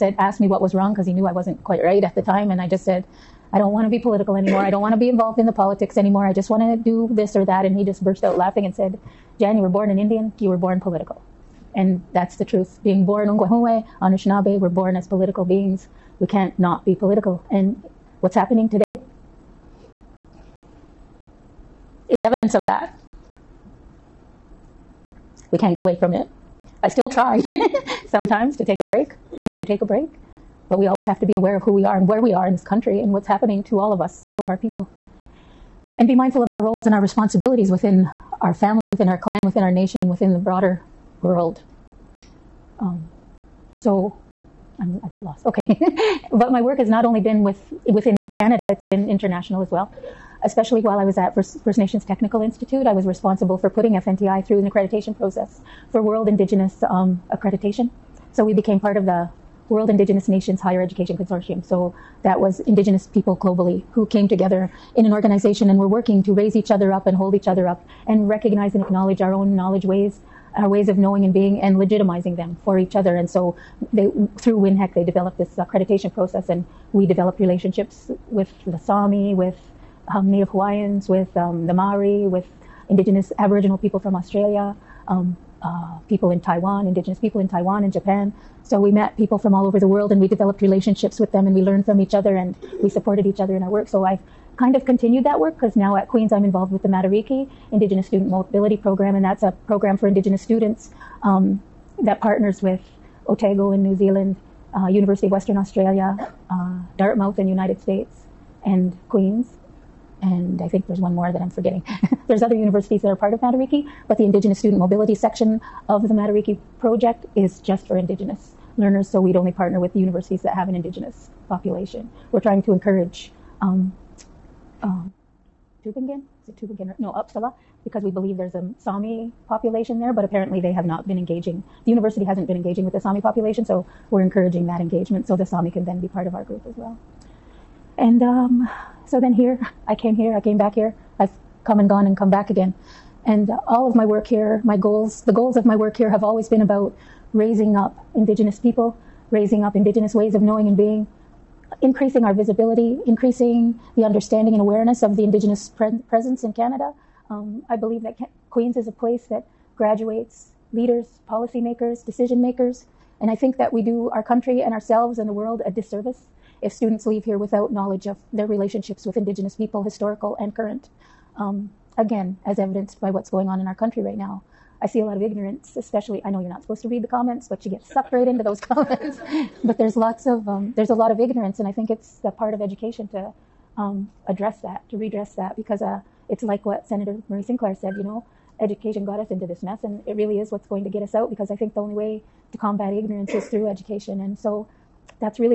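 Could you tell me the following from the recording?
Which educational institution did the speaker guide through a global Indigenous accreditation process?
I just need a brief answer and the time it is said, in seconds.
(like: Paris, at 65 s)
First Nations Technical Institute, at 51 s.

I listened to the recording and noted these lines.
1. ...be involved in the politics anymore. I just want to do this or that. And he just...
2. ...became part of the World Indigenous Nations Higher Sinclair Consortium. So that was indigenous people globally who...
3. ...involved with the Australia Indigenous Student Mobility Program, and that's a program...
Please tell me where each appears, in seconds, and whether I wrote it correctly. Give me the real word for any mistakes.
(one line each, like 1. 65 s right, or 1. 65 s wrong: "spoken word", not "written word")
1. 4 s right
2. 58 s wrong: "Education", not "Sinclair"
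3. 96 s wrong: "Matariki", not "Australia".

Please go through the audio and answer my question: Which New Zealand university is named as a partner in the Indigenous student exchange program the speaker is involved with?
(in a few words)
Otago.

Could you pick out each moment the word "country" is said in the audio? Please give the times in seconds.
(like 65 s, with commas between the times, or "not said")
32 s, 164 s, 173 s.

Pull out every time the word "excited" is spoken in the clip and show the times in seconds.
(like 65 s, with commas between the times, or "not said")
not said.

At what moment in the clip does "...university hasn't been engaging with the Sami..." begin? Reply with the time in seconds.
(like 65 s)
131 s.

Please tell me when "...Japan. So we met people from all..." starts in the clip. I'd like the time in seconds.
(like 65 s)
87 s.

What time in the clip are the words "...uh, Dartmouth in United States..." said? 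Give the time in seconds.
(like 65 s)
106 s.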